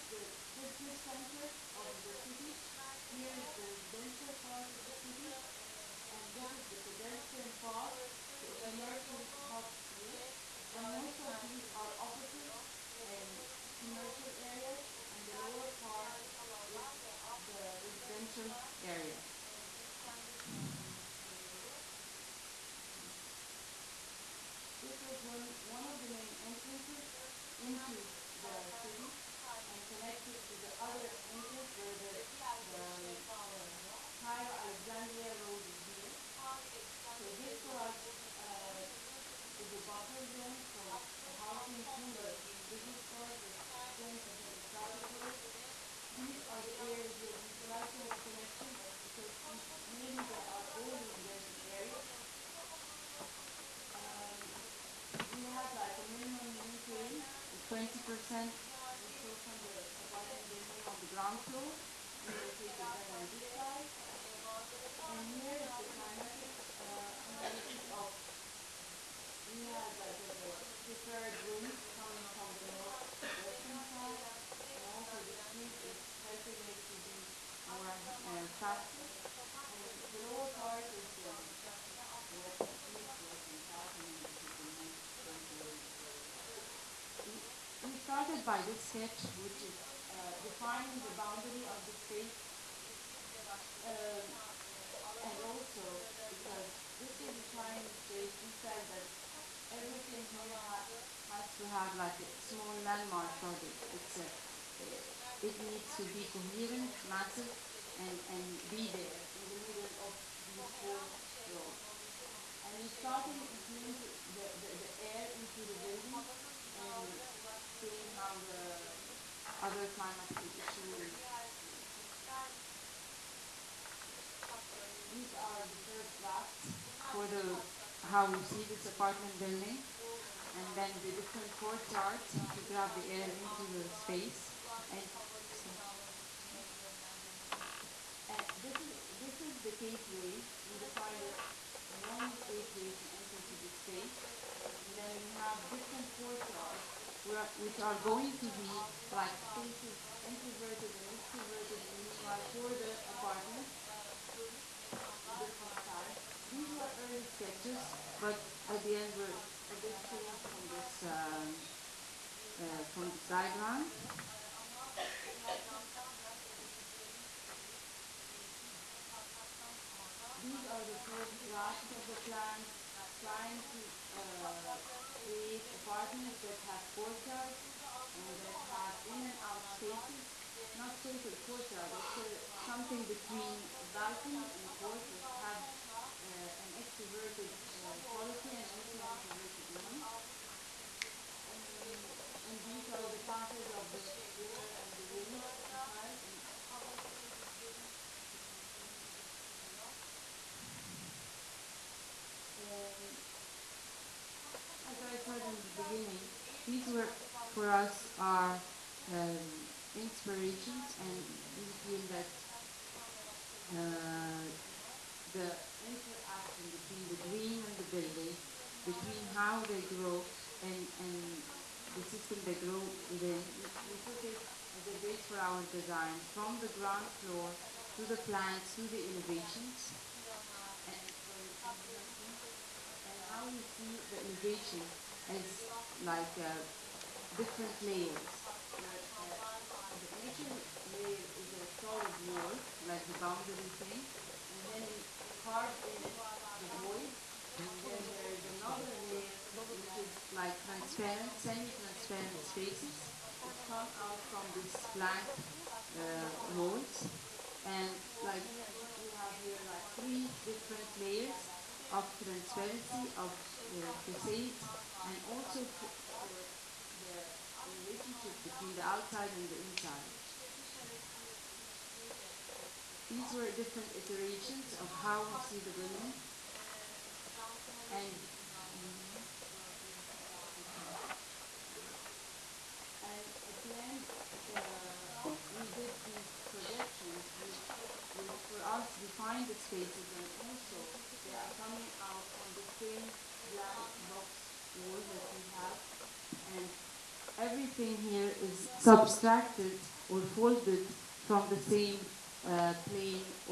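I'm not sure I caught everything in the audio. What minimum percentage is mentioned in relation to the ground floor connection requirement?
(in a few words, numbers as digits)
20%.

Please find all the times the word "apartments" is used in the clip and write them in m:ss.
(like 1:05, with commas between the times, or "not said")
2:08, 2:33, 2:55.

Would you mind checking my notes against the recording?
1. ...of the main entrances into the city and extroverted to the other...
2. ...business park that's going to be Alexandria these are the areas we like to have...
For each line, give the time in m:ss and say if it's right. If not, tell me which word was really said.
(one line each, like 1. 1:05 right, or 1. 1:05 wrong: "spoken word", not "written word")
1. 0:25 wrong: "connected", not "extroverted"
2. 0:42 wrong: "Probably", not "Alexandria".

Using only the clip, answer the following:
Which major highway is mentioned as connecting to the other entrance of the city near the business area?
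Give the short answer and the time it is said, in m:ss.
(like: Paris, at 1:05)
Cairo Alexandria Road, at 0:34.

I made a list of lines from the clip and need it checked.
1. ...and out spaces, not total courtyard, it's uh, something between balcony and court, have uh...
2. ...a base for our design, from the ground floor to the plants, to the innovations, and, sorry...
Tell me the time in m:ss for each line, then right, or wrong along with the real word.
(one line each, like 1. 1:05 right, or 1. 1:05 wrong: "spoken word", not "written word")
1. 2:59 right
2. 3:44 right.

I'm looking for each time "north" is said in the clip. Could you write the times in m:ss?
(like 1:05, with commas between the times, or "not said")
1:12, 1:24.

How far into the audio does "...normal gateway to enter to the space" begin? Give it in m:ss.
2:22.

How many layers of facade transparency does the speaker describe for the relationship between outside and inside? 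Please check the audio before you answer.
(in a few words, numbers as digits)
3.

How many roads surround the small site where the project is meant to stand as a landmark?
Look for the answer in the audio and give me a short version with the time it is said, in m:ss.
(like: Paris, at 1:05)
4, at 1:50.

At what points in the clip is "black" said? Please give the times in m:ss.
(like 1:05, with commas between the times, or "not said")
4:14, 4:53.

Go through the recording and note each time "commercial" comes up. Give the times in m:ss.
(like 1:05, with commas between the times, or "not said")
0:08, 0:13.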